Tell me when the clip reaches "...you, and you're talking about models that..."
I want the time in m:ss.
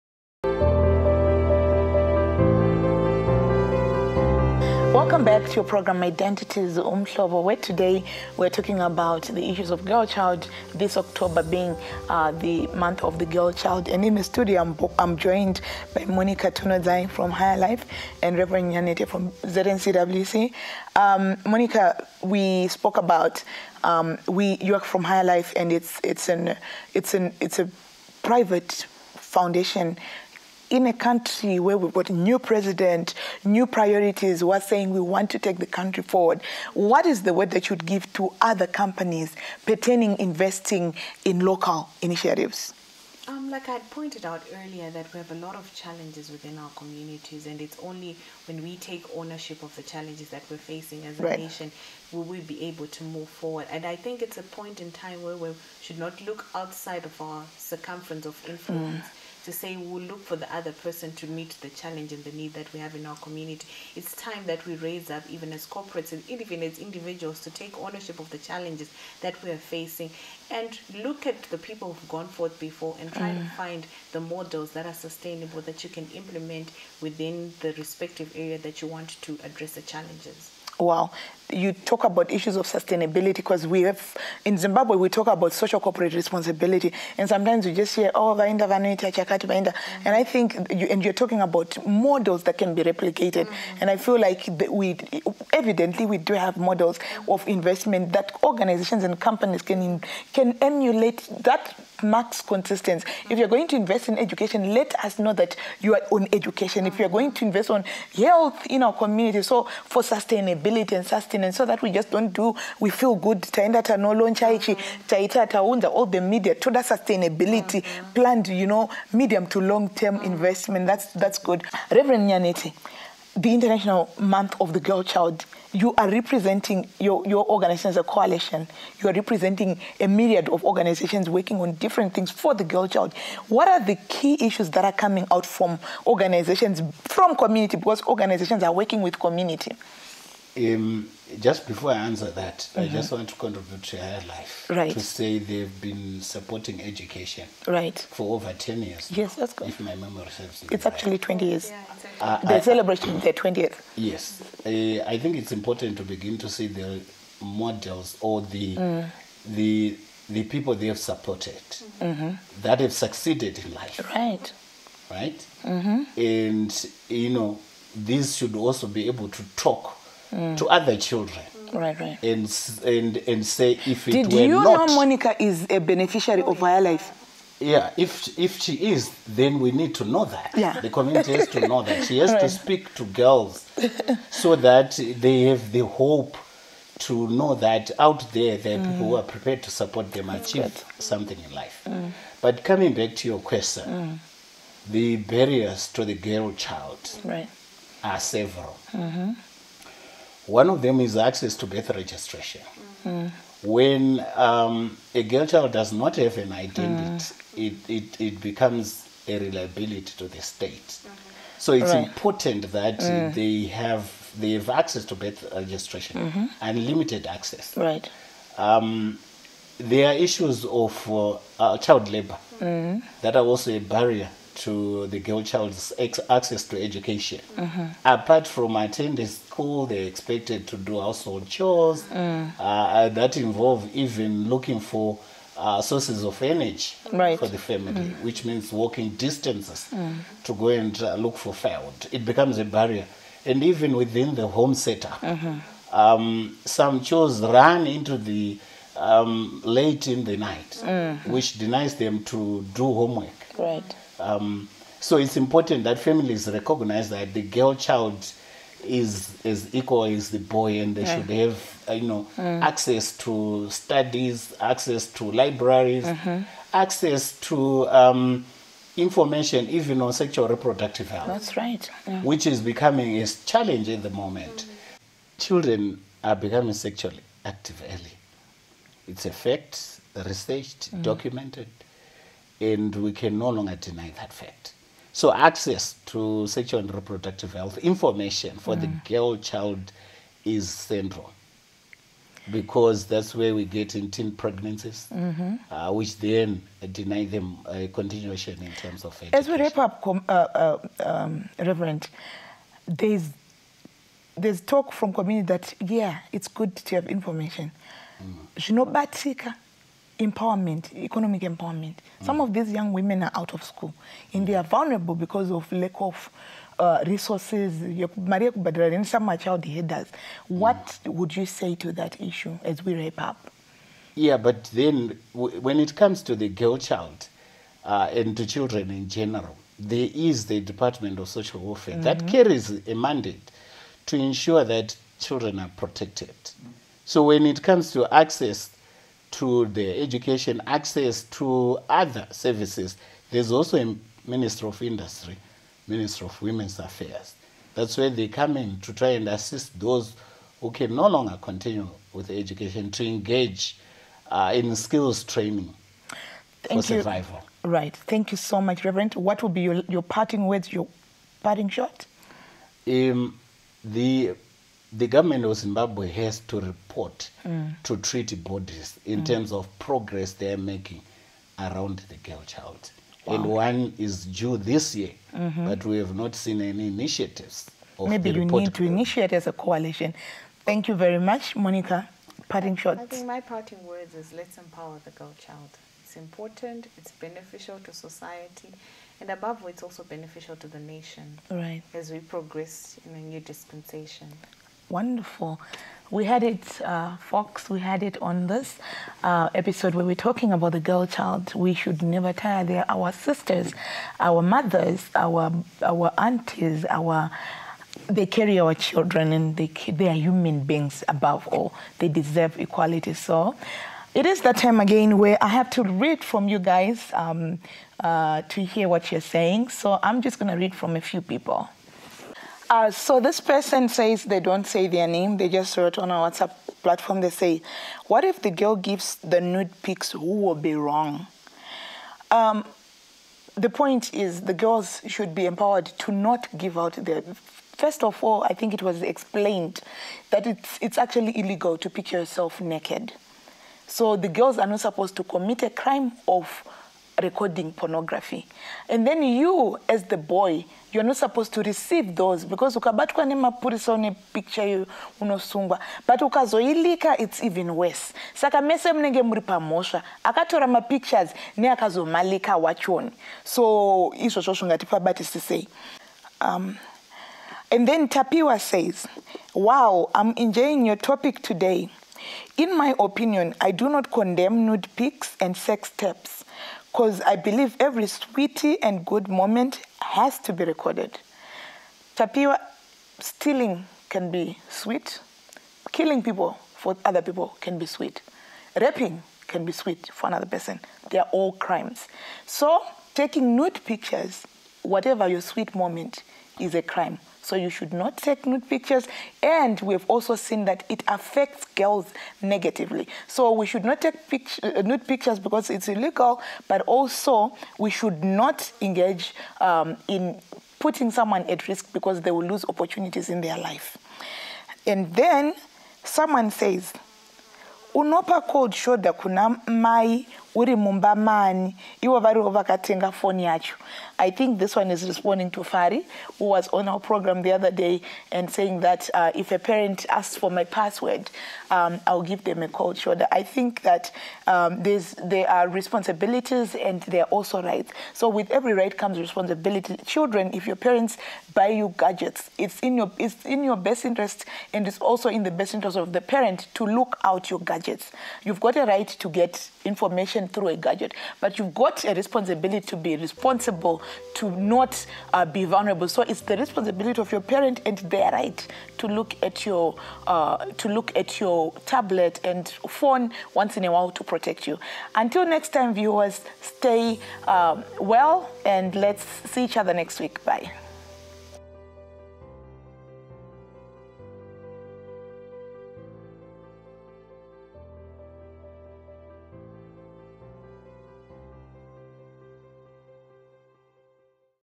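1:30.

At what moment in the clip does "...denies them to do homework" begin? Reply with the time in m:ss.
4:11.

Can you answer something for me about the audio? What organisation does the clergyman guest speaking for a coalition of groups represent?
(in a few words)
ZNCWC.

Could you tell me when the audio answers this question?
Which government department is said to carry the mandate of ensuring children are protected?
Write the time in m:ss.
5:30.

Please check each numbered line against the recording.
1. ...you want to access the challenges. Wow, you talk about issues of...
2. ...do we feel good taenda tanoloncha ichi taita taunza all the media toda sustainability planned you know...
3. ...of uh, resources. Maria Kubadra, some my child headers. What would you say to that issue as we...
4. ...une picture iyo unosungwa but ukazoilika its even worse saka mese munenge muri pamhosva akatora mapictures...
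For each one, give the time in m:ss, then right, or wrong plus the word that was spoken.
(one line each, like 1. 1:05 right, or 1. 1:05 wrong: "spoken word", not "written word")
1. 1:18 wrong: "address", not "access"
2. 1:52 right
3. 5:15 right
4. 7:33 right.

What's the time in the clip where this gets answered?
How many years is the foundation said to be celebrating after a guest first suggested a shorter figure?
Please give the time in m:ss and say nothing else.
2:31.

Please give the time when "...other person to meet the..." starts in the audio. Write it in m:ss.
1:00.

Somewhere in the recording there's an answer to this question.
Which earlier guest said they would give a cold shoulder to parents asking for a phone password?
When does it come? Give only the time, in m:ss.
8:45.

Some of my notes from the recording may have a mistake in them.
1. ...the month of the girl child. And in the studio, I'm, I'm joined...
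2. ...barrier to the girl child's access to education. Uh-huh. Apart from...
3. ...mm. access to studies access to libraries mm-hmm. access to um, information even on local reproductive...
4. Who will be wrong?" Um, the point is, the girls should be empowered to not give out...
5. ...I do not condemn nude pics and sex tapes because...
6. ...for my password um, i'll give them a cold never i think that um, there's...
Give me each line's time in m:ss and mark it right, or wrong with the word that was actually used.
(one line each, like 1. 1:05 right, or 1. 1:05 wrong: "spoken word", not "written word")
1. 0:12 right
2. 3:43 right
3. 4:22 wrong: "sexual", not "local"
4. 7:10 right
5. 7:53 right
6. 8:50 wrong: "shoulder", not "never".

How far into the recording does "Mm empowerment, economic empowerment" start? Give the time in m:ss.
5:08.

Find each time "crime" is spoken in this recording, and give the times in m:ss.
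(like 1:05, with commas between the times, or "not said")
7:25, 8:11, 8:16.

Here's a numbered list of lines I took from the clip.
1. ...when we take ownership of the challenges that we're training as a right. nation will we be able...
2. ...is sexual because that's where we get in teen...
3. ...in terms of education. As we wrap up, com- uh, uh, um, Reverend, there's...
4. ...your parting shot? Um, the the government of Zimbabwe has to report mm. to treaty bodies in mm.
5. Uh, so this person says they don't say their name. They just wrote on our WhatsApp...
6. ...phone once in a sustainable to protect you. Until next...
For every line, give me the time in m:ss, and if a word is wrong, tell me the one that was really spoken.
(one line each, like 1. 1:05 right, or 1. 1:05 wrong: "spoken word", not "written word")
1. 0:48 wrong: "facing", not "training"
2. 4:50 wrong: "central", not "sexual"
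3. 4:58 right
4. 6:00 right
5. 7:02 right
6. 9:22 wrong: "while", not "sustainable".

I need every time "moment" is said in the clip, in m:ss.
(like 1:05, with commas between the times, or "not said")
4:34, 7:59, 8:15.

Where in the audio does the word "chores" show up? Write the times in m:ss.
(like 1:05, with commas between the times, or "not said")
3:51, 4:07.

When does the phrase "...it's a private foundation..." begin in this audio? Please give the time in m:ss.
0:27.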